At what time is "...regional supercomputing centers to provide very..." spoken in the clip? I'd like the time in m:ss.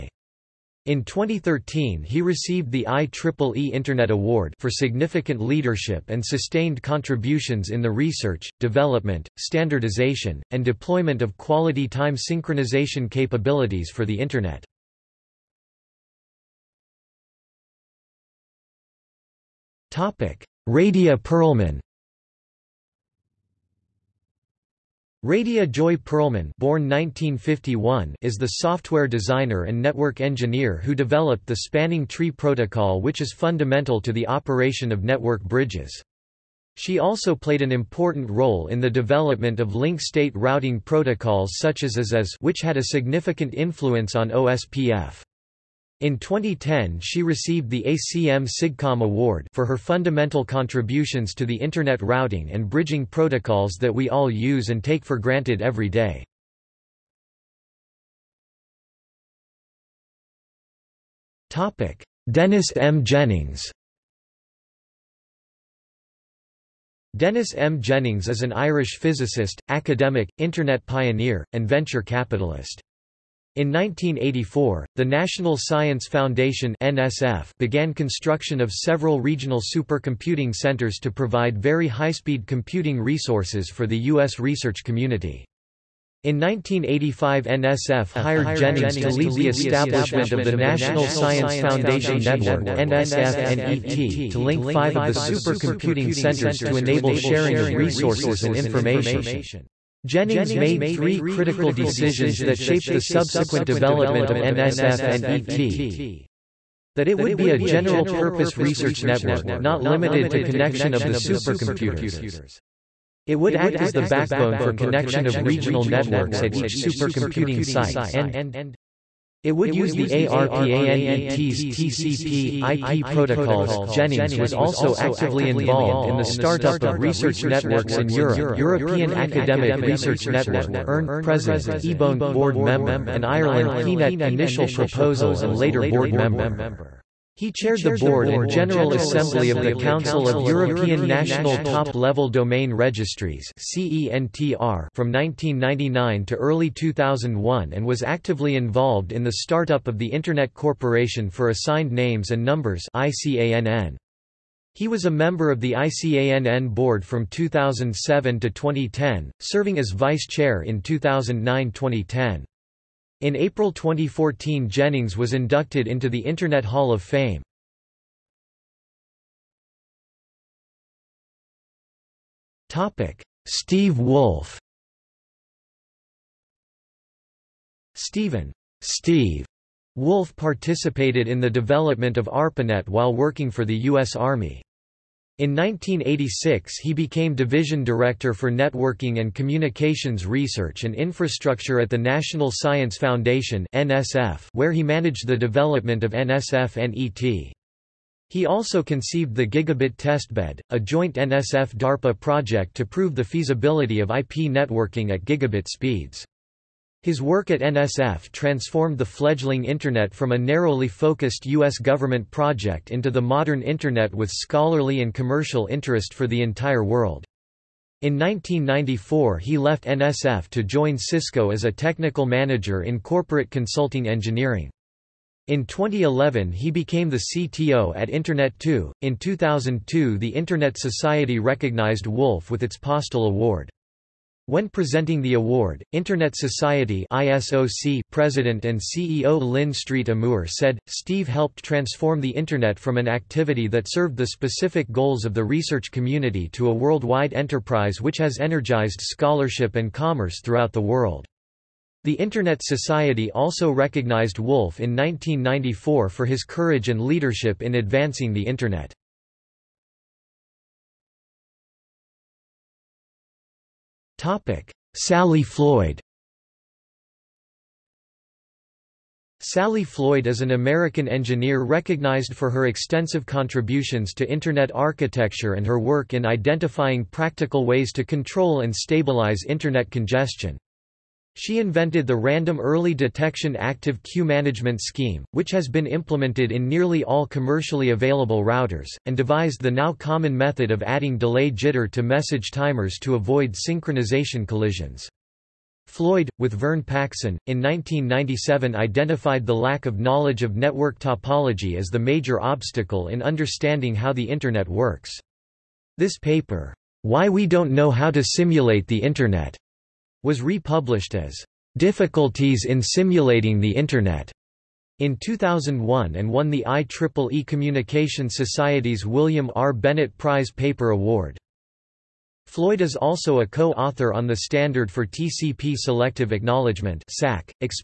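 1:19.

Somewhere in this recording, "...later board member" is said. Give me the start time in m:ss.
2:15.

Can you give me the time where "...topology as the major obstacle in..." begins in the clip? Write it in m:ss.
5:01.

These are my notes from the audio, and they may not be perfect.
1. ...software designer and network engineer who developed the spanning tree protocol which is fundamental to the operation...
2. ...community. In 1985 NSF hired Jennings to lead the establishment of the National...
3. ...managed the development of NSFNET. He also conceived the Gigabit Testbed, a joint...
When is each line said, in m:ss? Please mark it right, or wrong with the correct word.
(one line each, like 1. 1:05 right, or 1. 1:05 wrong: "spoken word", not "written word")
1. 0:28 right
2. 1:24 right
3. 3:14 right.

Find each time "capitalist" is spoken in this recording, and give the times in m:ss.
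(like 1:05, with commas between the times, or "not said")
1:12.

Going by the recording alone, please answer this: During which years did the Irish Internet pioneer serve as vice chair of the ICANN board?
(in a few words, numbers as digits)
2009-2010.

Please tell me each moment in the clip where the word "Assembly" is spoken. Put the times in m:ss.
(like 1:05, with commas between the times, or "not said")
2:18.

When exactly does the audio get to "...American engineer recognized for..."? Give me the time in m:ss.
4:30.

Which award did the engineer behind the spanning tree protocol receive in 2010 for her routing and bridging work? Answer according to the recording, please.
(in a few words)
ACM SIGCOMM Award.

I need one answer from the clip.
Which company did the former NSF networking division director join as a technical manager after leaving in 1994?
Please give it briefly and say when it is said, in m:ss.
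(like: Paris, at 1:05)
Cisco, at 3:40.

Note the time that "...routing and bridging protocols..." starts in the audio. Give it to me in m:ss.
0:52.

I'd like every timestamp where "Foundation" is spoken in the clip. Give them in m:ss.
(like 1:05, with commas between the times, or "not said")
1:16, 1:31, 3:12.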